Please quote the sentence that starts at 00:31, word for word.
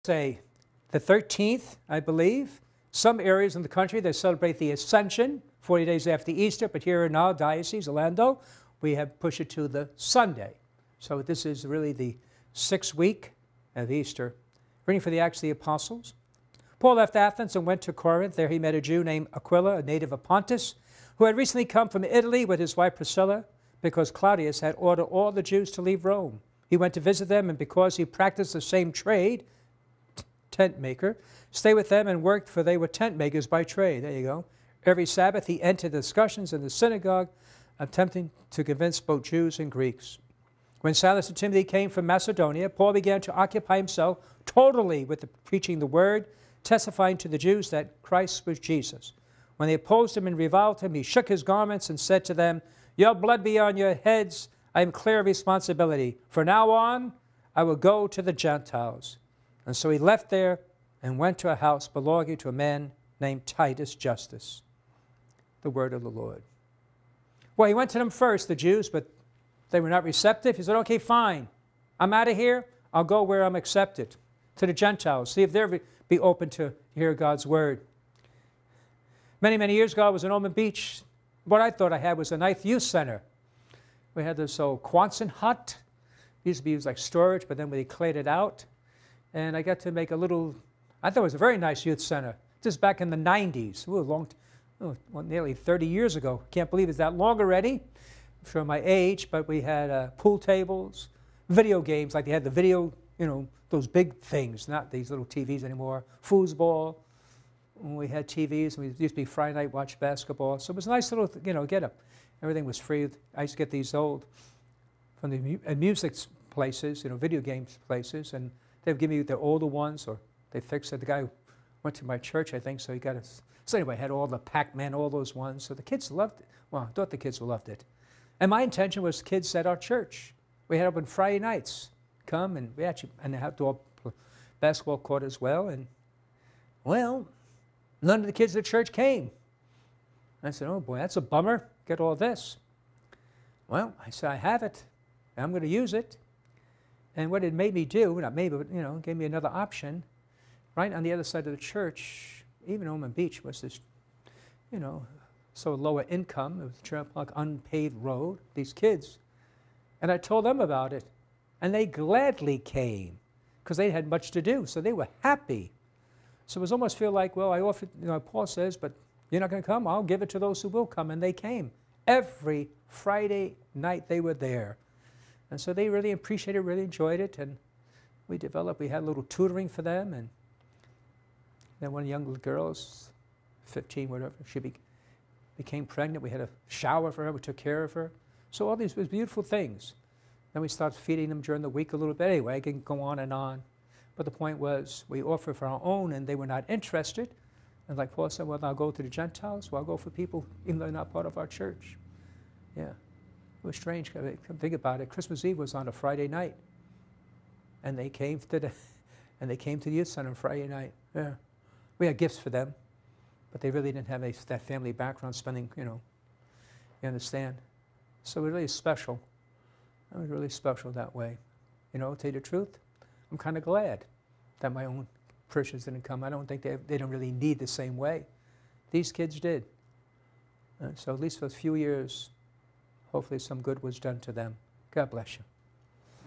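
stay with them and worked, for they were tent makers by trade.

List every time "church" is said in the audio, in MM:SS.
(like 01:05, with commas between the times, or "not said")
02:02, 02:09, 02:18, 02:31, 03:21.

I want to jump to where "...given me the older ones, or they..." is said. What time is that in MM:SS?
01:58.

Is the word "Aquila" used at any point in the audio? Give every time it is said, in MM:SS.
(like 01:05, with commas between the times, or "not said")
00:19.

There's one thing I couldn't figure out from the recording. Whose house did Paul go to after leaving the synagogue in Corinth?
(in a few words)
Titus Justus.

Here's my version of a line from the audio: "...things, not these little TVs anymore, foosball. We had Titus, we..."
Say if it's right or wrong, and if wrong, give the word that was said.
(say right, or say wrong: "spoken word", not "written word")
wrong: "TVs", not "Titus".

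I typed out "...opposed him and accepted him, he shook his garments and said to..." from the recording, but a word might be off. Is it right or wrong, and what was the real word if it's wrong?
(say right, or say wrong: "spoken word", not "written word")
wrong: "reviled", not "accepted".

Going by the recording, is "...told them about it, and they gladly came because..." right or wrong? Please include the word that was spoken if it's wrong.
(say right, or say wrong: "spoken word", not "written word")
right.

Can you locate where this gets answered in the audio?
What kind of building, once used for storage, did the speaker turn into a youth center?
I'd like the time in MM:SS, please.
01:24.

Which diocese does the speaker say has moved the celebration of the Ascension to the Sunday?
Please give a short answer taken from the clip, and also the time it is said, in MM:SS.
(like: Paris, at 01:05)
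Orlando, at 00:07.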